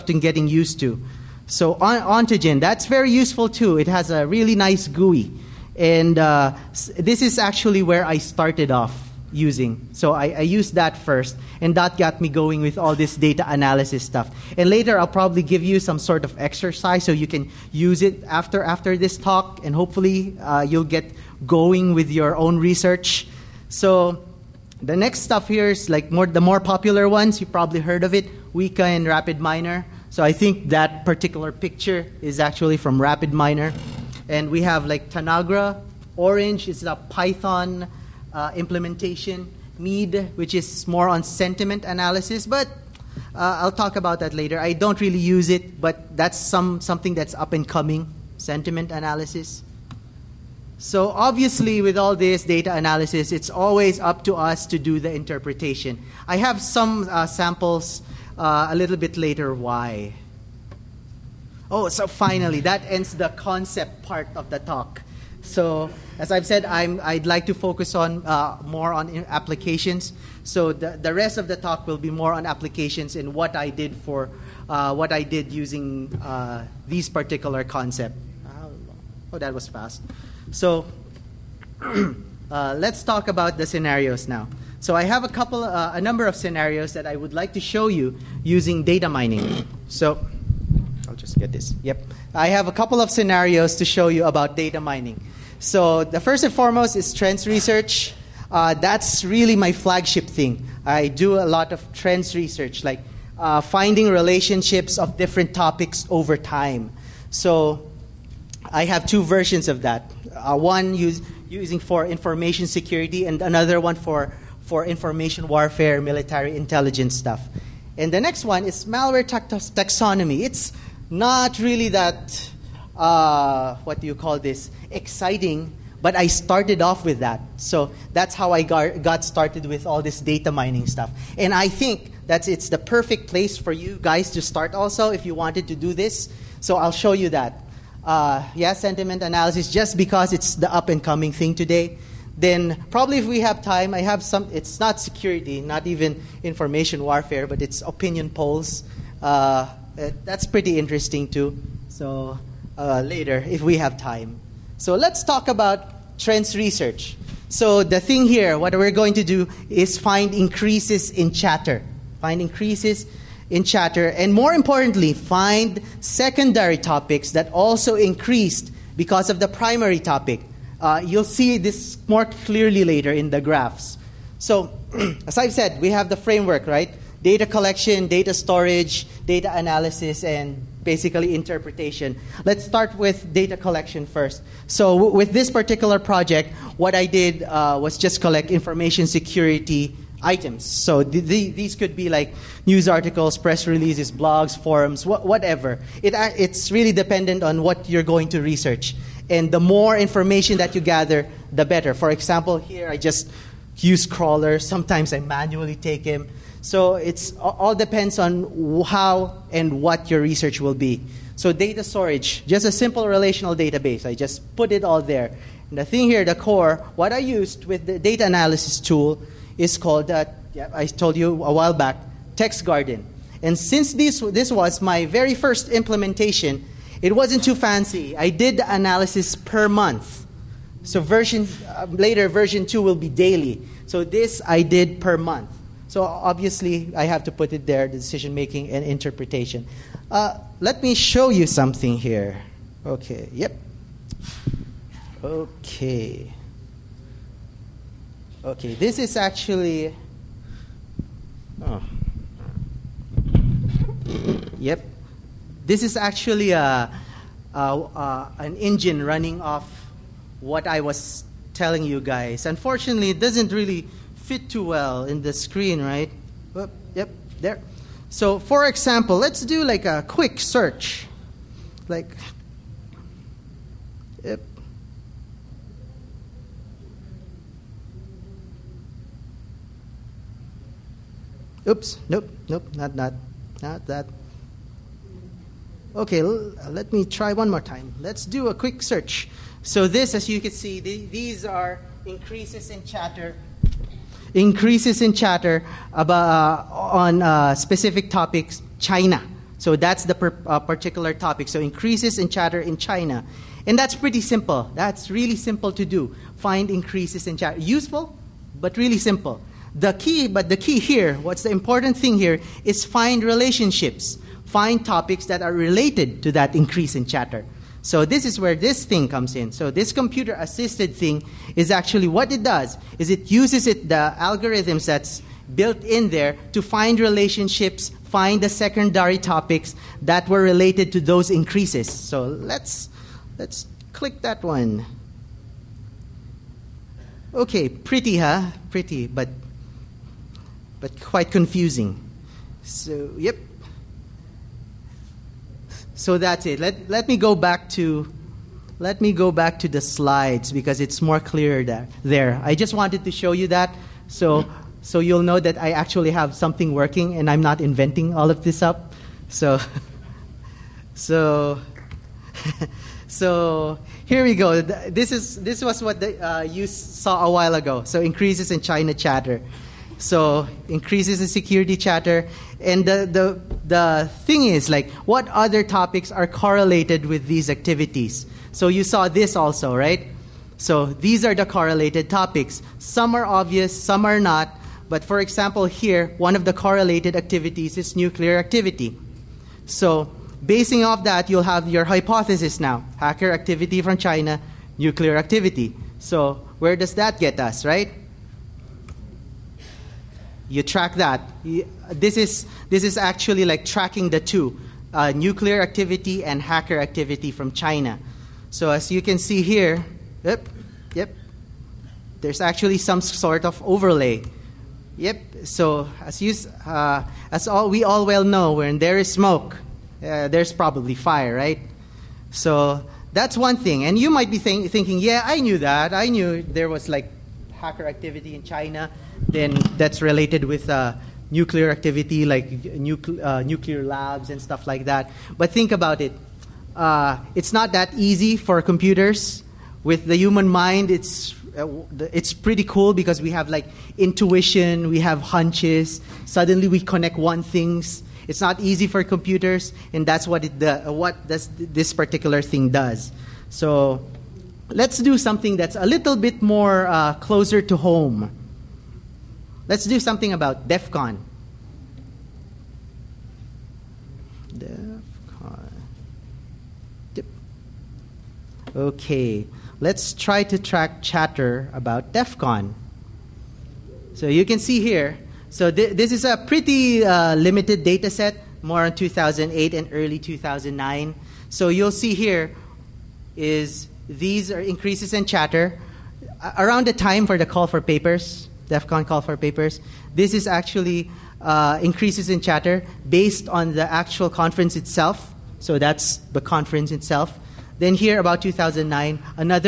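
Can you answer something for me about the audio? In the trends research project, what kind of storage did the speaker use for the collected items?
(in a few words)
relational database.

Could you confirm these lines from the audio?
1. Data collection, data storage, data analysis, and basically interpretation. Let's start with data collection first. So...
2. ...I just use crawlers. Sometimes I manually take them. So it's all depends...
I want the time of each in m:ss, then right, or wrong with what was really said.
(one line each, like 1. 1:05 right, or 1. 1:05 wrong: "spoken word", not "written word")
1. 2:57 right
2. 3:22 right.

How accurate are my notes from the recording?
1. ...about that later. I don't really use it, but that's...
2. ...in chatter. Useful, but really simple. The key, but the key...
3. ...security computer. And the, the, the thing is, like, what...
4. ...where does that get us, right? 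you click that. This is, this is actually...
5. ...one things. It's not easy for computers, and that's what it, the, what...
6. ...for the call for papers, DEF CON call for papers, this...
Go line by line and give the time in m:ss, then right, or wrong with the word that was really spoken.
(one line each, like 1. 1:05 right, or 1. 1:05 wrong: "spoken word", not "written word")
1. 0:43 right
2. 5:07 right
3. 6:11 wrong: "chatter", not "computer"
4. 6:36 wrong: "track", not "click"
5. 7:27 right
6. 8:07 right.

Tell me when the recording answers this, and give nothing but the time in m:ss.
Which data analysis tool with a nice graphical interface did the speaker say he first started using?
0:02.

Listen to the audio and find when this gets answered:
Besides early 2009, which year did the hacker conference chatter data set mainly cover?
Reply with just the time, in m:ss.
7:58.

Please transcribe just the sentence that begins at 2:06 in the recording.
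But I started off with that.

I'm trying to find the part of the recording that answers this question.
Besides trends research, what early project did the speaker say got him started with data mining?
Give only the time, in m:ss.
1:58.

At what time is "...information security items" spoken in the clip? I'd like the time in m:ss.
3:08.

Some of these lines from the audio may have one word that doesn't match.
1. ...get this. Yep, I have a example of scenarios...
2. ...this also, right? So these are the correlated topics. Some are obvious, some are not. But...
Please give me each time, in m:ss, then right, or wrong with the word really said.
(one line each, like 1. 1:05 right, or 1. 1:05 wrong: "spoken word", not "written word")
1. 1:31 wrong: "couple", not "example"
2. 6:19 right.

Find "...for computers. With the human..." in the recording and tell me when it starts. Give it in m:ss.
7:18.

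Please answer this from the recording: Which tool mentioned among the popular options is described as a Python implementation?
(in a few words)
Orange.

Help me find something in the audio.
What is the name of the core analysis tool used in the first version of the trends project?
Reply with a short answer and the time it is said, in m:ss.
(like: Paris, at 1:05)
Text Garden, at 3:42.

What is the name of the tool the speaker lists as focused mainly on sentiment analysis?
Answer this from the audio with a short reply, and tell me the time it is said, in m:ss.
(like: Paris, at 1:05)
Mead, at 0:39.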